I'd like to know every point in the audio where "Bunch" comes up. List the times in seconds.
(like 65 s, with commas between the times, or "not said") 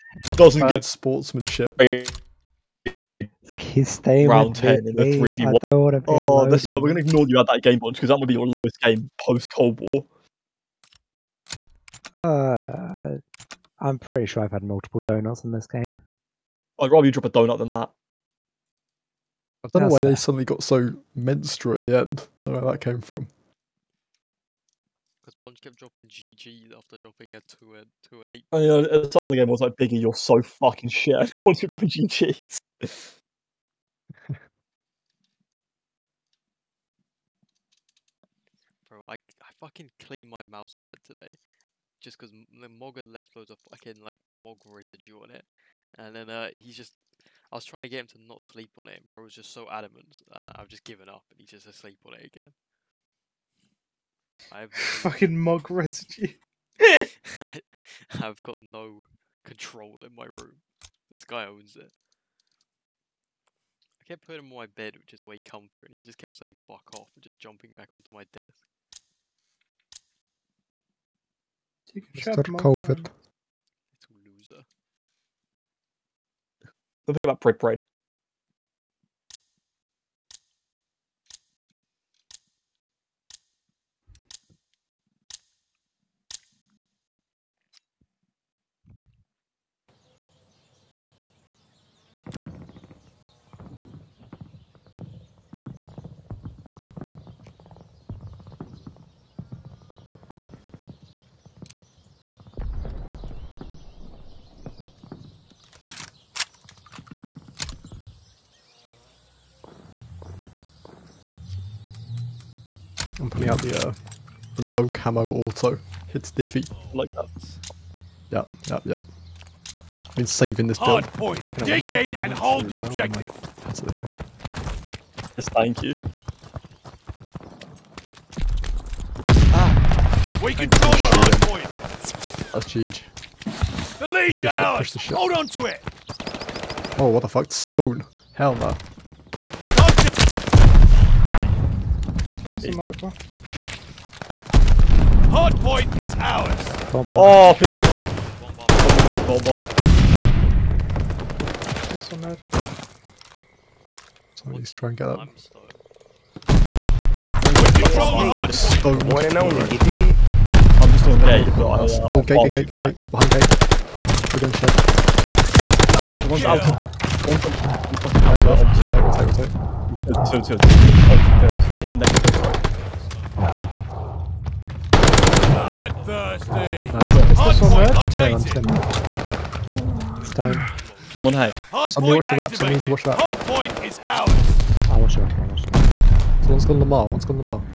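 7 s, 25 s, 31 s.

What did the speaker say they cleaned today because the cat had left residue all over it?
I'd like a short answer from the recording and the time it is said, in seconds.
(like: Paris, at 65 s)
mouse pad, at 40 s.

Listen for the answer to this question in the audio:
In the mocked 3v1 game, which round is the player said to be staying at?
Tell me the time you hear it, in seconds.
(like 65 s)
4 s.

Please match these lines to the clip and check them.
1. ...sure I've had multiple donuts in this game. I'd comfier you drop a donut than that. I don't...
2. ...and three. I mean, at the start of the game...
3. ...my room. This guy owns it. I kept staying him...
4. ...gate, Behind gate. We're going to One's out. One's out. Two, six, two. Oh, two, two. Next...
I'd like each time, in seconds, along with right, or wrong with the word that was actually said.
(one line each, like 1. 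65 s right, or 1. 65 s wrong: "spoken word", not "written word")
1. 14 s wrong: "rather", not "comfier"
2. 28 s wrong: "eight", not "three"
3. 60 s wrong: "putting", not "staying"
4. 162 s wrong: "two", not "six".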